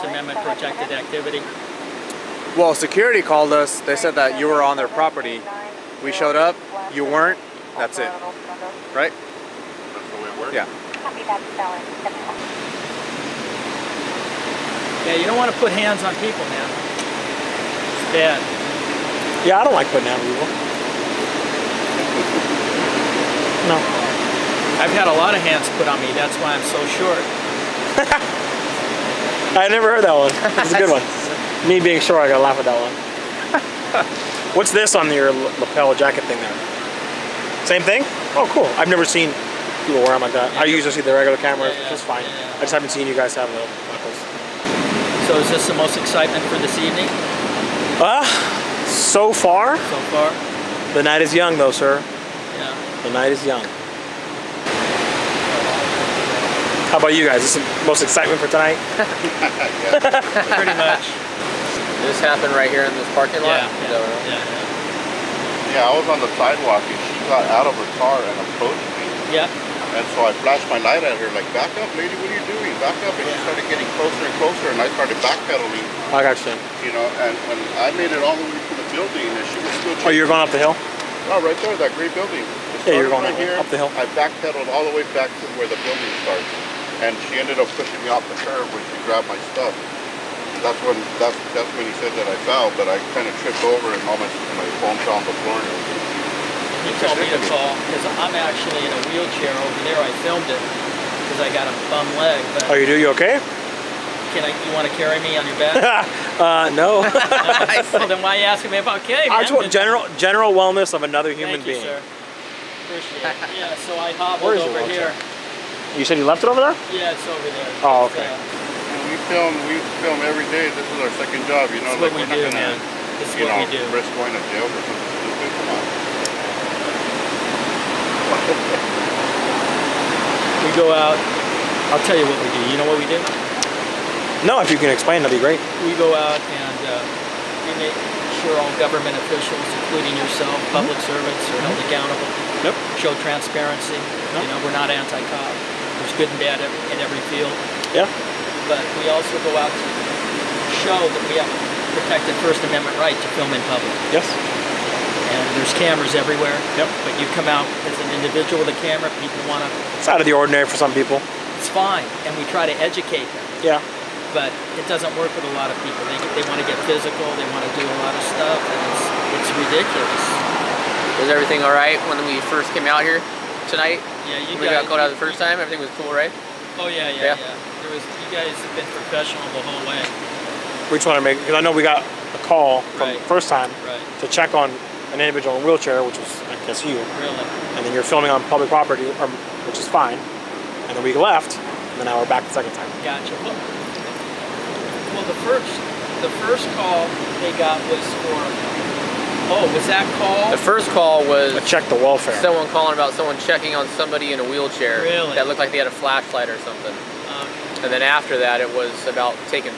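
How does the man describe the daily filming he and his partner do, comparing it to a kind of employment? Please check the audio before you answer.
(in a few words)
second job.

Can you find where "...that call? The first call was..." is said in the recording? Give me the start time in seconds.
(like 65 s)
199 s.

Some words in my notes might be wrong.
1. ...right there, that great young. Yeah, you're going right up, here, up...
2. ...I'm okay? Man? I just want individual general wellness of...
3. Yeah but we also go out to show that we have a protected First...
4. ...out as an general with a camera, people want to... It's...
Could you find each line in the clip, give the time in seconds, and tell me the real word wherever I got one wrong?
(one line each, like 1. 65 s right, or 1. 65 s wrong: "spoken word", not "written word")
1. 81 s wrong: "building", not "young"
2. 108 s wrong: "general", not "individual"
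3. 147 s right
4. 157 s wrong: "individual", not "general".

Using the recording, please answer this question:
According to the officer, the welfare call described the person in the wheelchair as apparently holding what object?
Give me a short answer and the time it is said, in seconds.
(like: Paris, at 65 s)
flashlight, at 205 s.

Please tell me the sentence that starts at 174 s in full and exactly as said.
Yeah, you we got, got, out the first time.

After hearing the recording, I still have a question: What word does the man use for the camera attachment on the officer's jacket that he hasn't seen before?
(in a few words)
buckles.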